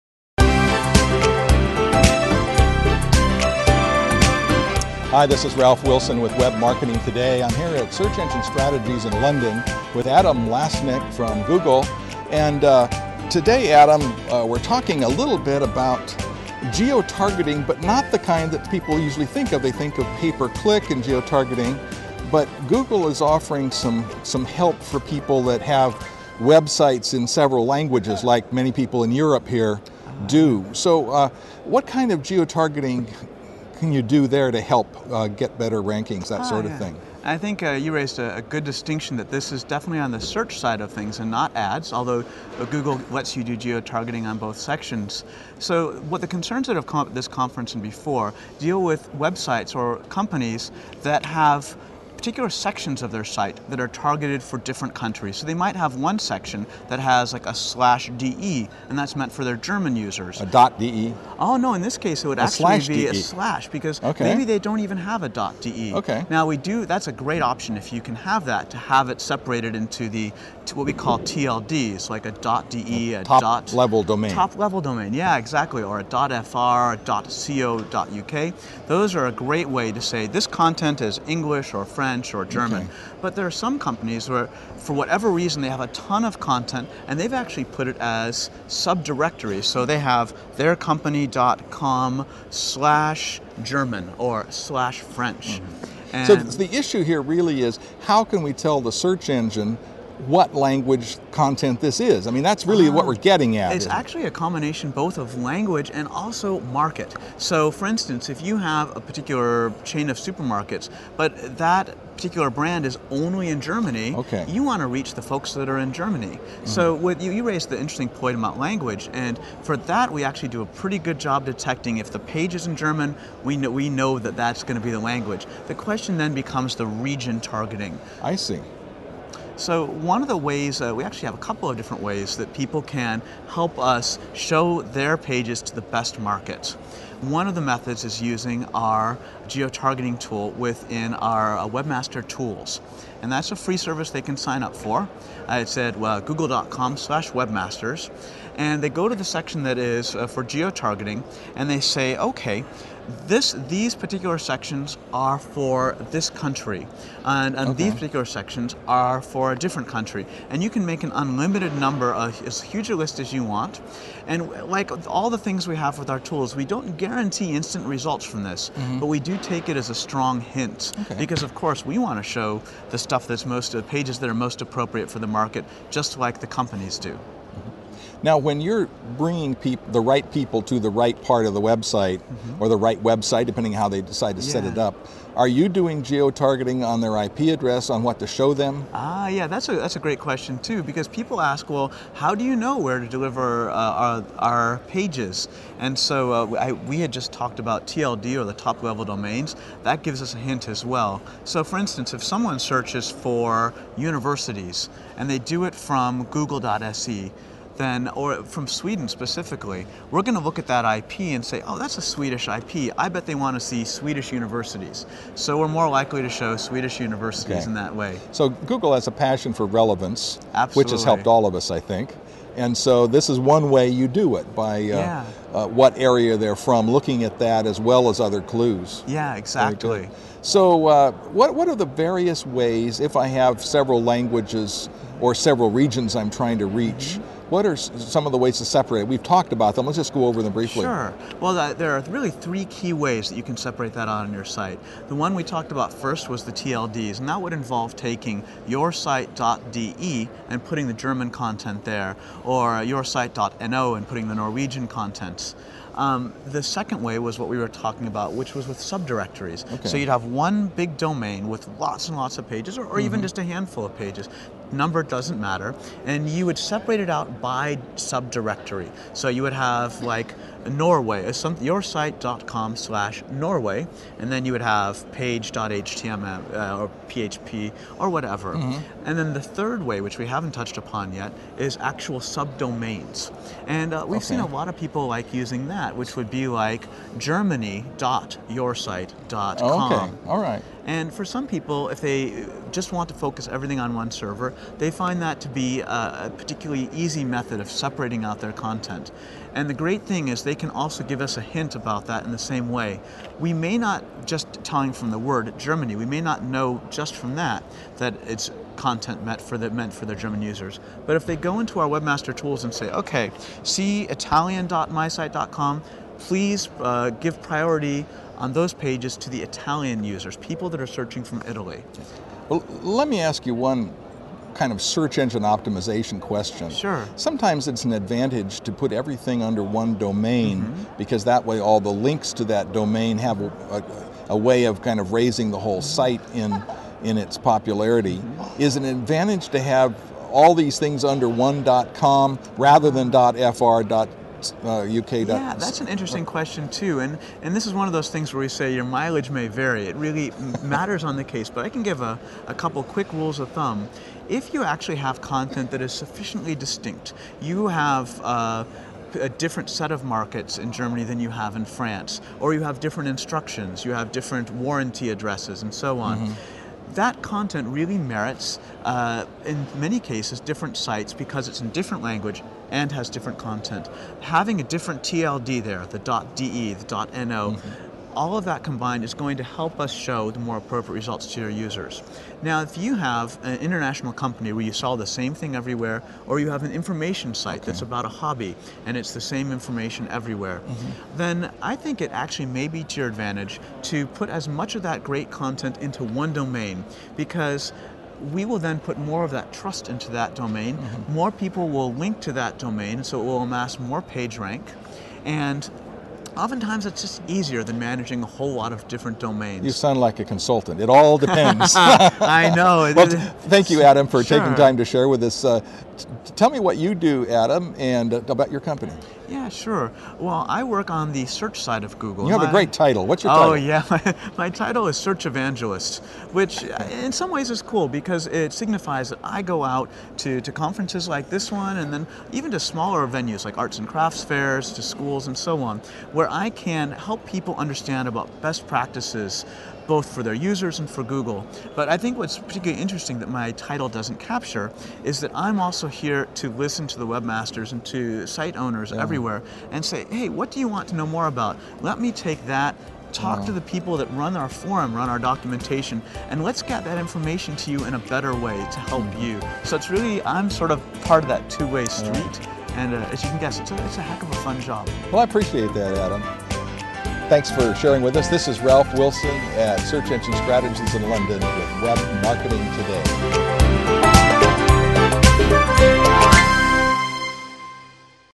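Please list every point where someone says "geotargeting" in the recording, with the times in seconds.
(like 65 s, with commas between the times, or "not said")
139 s, 150 s.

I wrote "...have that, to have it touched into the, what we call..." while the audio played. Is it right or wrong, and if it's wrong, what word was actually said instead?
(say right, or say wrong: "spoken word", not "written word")
wrong: "separated", not "touched".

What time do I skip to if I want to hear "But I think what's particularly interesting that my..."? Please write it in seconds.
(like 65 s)
441 s.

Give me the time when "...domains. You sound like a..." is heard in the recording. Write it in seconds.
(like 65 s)
409 s.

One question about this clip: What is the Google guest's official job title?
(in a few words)
Search Evangelist.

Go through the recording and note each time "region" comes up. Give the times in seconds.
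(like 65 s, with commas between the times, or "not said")
126 s, 235 s.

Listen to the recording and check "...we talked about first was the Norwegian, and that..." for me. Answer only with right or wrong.
wrong.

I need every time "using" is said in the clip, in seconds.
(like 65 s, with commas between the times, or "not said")
138 s, 285 s.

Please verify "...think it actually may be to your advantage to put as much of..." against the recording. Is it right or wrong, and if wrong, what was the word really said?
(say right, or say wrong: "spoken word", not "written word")
right.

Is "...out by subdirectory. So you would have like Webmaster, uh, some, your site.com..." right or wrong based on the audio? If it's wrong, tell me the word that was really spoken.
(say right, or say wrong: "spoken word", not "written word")
wrong: "Norway", not "Webmaster".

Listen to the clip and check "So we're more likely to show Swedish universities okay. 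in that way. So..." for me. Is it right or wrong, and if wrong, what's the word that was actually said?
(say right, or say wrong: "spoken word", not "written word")
right.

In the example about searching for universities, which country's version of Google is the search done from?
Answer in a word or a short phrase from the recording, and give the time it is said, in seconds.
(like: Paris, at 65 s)
Sweden, at 206 s.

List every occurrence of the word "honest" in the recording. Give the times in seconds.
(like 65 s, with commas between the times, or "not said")
not said.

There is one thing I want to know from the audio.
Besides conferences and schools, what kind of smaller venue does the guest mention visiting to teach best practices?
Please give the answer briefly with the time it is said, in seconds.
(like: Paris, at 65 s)
arts and crafts fairs, at 433 s.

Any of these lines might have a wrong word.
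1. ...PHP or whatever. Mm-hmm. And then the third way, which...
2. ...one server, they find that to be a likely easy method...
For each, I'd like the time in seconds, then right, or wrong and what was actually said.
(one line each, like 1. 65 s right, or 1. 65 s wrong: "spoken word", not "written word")
1. 277 s right
2. 293 s wrong: "particularly", not "likely".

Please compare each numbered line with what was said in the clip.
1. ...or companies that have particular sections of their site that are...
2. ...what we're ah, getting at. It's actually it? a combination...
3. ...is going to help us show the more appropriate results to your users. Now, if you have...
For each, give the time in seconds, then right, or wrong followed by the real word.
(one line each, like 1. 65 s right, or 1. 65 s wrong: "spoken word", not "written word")
1. 49 s right
2. 102 s right
3. 379 s right.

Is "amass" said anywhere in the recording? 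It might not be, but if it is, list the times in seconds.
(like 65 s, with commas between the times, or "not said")
403 s.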